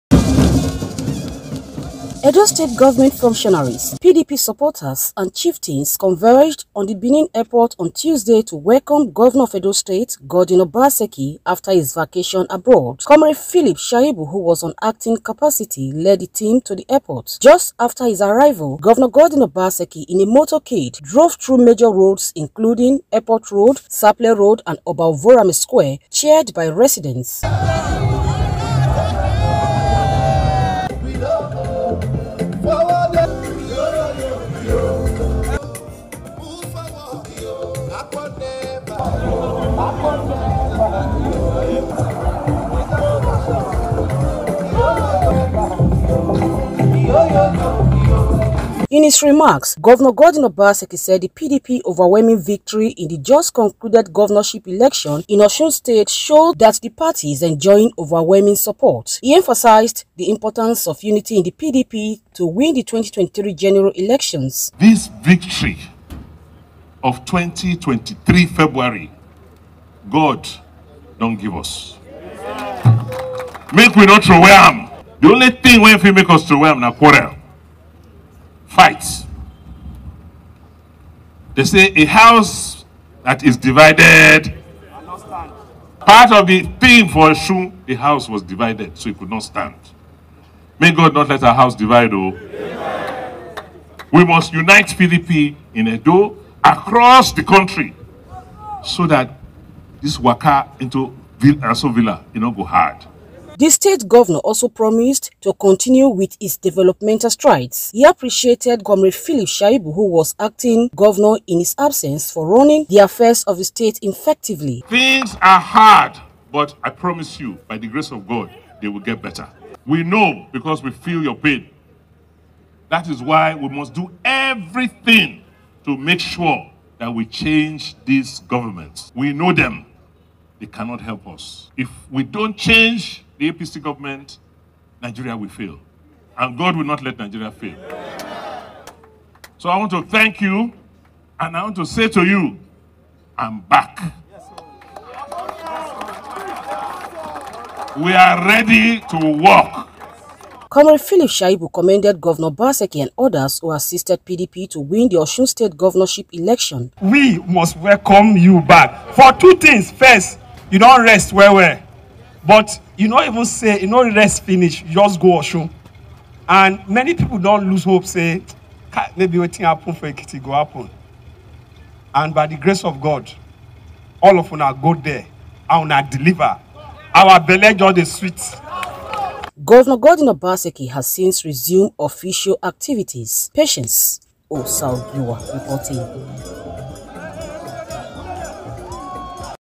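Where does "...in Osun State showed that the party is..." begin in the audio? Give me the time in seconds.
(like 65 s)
55 s.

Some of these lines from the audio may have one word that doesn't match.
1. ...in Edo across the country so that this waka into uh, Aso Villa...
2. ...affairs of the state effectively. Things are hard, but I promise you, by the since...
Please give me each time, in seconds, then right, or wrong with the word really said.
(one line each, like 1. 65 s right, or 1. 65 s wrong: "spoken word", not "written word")
1. 95 s right
2. 112 s wrong: "grace", not "since".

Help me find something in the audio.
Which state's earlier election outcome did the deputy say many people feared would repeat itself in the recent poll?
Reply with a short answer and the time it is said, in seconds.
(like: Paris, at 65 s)
Ekiti, at 170 s.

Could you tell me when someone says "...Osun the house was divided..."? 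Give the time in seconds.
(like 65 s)
87 s.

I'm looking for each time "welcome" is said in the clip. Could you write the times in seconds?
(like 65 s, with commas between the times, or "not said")
8 s, 157 s.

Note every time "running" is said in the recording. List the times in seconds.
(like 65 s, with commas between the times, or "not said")
112 s.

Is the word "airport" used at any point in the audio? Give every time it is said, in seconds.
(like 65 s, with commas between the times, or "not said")
7 s, 16 s, 23 s.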